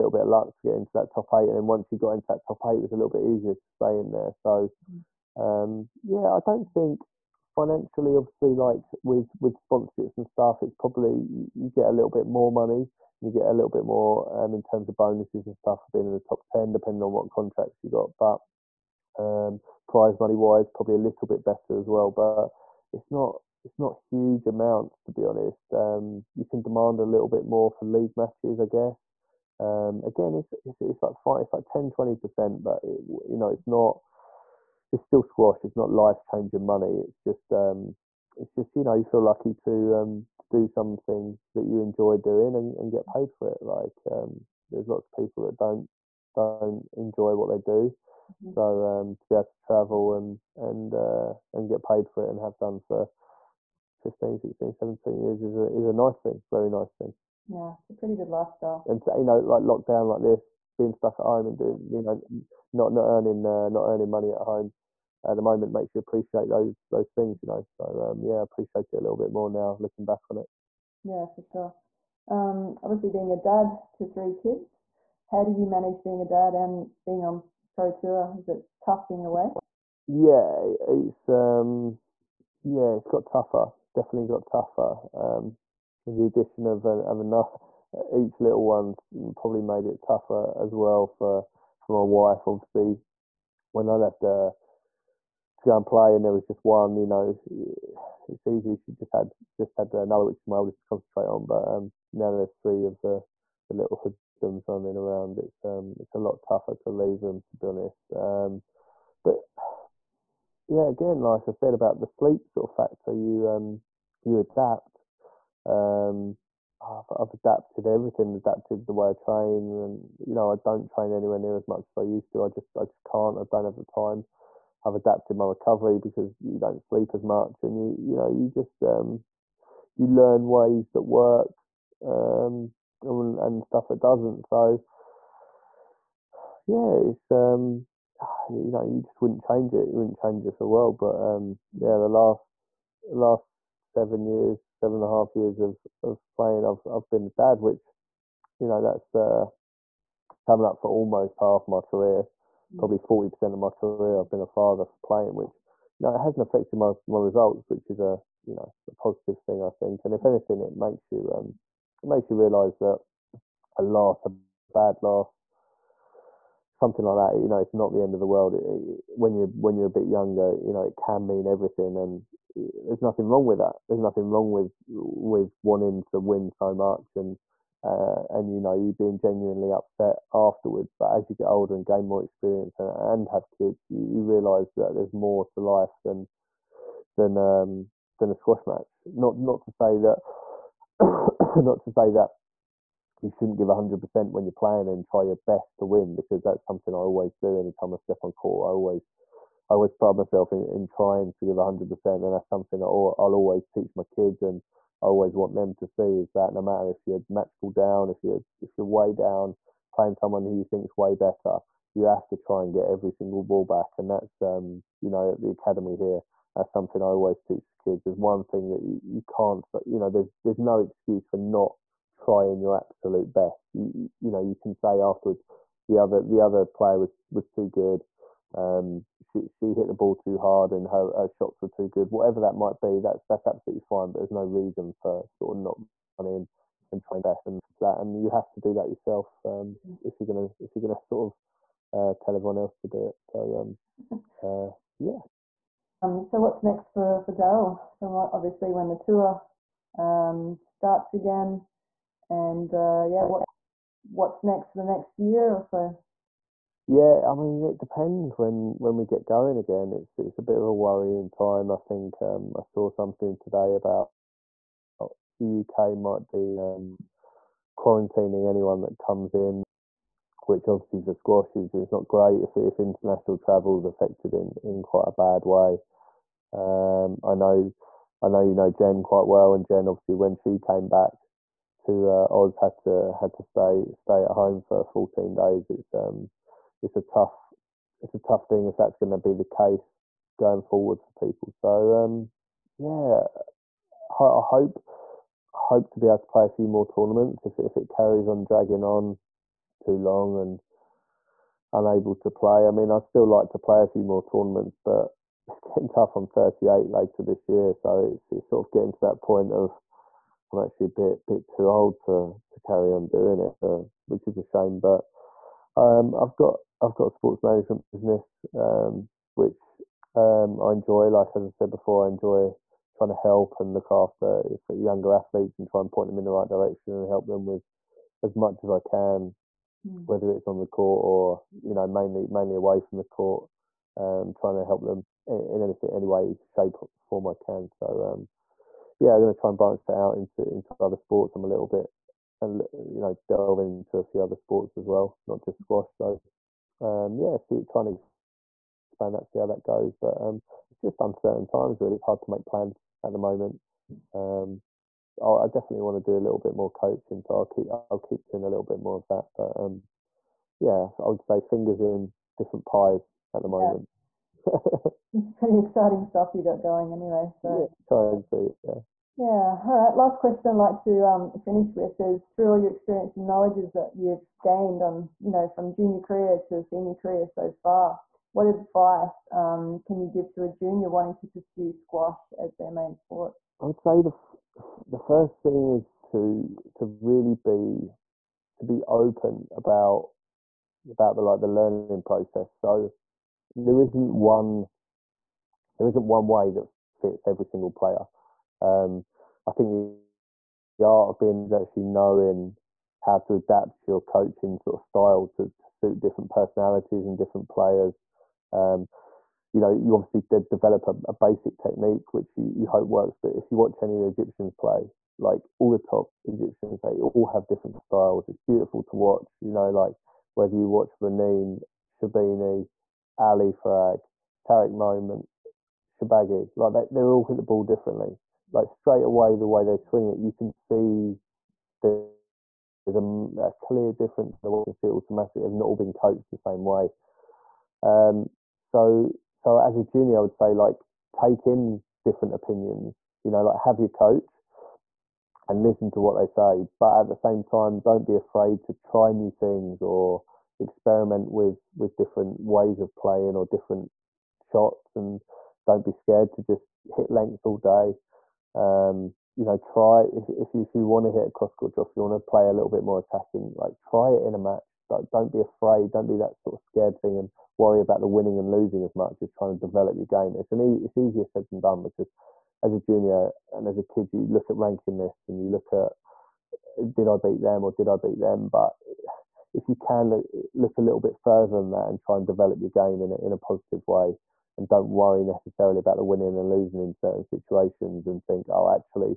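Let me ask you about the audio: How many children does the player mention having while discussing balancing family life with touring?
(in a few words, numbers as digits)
3.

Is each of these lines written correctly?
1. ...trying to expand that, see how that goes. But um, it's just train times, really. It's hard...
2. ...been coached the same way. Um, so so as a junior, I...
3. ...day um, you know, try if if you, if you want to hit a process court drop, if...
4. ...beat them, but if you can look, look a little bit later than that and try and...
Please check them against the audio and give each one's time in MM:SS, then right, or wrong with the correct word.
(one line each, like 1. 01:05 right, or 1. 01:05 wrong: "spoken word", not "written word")
1. 05:47 wrong: "uncertain", not "train"
2. 07:15 right
3. 07:37 wrong: "cross", not "process"
4. 07:57 wrong: "further", not "later".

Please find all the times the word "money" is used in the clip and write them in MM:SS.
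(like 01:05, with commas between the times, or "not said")
00:12, 00:20, 00:36, 01:04.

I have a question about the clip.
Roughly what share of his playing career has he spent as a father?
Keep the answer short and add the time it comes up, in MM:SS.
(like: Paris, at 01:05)
40%, at 02:32.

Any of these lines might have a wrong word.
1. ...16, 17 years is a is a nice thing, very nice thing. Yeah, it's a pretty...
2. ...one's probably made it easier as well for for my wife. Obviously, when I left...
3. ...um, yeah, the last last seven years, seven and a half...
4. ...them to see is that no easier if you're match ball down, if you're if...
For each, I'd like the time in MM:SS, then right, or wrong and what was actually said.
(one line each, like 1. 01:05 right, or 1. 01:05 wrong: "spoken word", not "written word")
1. 00:54 right
2. 01:28 wrong: "tougher", not "easier"
3. 02:21 right
4. 03:25 wrong: "matter", not "easier".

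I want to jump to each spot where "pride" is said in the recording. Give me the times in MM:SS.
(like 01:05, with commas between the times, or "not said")
03:19.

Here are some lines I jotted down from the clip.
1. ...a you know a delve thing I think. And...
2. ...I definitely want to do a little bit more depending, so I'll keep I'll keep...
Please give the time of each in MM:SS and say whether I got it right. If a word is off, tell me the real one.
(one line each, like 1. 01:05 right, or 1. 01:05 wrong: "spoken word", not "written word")
1. 02:37 wrong: "positive", not "delve"
2. 05:55 wrong: "coaching", not "depending".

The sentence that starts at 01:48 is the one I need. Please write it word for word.
Um, but yeah, again, like I said about the sleep sort of factor, you um, you adapt.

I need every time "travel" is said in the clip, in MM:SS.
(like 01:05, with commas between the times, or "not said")
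00:49, 04:33.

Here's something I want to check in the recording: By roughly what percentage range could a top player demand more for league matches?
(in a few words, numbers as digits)
10 to 20%.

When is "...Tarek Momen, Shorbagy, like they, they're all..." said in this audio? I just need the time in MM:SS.
07:04.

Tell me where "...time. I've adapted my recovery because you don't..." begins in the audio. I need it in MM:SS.
02:03.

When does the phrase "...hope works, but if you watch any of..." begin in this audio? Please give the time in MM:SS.
06:52.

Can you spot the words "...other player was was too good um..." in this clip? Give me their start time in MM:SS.
03:46.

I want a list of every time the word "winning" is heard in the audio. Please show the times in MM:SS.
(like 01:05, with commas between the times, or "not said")
07:48, 08:06.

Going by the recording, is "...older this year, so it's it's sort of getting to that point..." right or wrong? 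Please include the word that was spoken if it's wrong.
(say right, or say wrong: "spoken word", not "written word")
wrong: "later", not "older".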